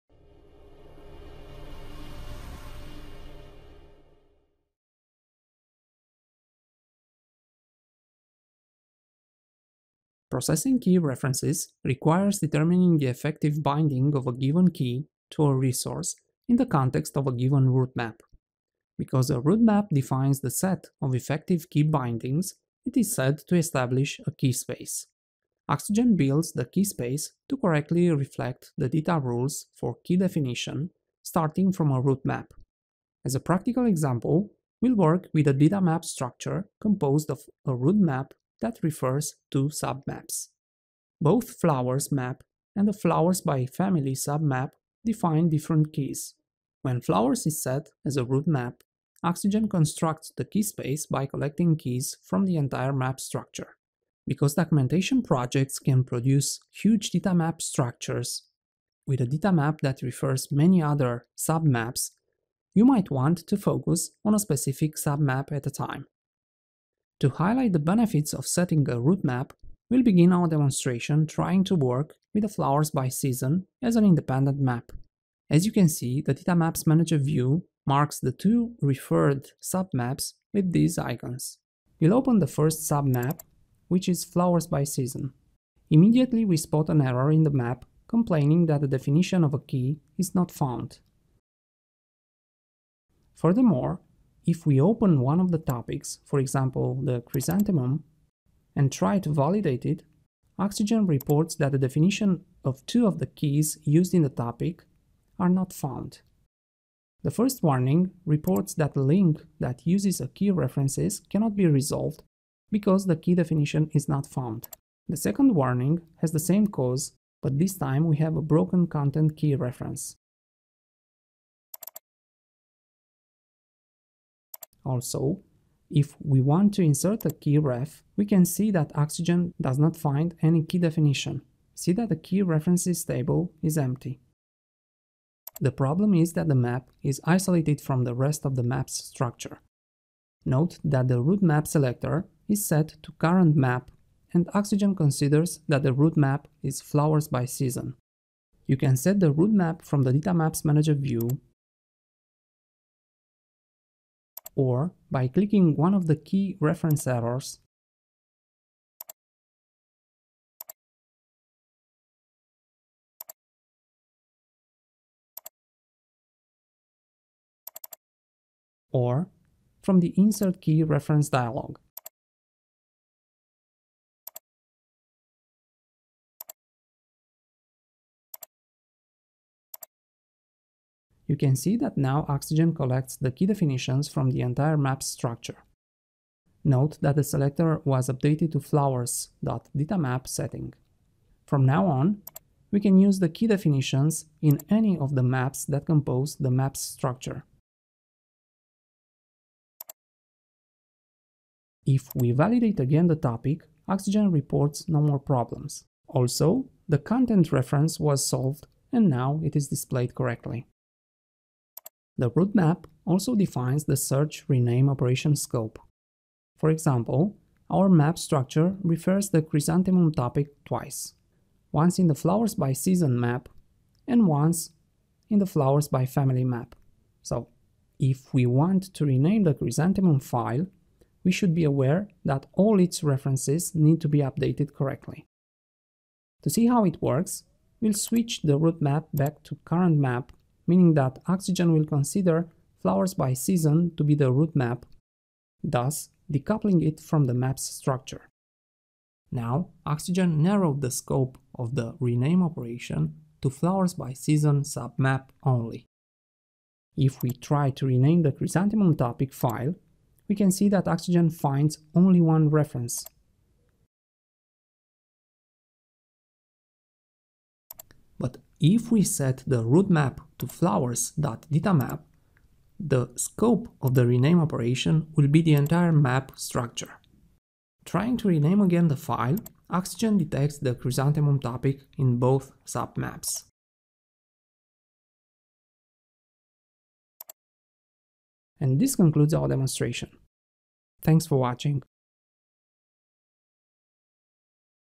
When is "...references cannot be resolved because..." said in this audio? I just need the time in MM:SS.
01:50.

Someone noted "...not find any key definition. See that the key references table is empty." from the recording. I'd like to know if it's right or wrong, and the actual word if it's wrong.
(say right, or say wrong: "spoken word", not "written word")
right.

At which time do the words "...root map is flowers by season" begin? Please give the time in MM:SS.
02:25.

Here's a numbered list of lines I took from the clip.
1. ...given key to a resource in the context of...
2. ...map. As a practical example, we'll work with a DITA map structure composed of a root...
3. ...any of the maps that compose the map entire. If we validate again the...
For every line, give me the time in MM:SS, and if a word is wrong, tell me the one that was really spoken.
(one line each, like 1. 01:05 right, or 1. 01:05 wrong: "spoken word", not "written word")
1. 00:14 right
2. 00:32 right
3. 03:14 wrong: "structure", not "entire".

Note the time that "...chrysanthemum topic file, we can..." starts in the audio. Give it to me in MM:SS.
04:18.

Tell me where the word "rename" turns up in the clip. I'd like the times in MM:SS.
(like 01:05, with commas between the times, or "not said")
03:34, 03:49, 04:11, 04:17, 04:34, 04:38.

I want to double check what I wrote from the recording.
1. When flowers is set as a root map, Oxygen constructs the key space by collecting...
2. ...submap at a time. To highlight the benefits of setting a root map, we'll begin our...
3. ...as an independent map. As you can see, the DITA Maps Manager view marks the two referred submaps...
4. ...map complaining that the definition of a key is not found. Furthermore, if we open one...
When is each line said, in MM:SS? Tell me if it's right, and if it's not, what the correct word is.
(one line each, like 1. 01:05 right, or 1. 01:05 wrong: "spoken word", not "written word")
1. 00:46 right
2. 01:04 right
3. 01:13 right
4. 01:27 right.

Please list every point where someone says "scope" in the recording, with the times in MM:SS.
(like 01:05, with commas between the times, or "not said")
03:35, 04:10, 04:33.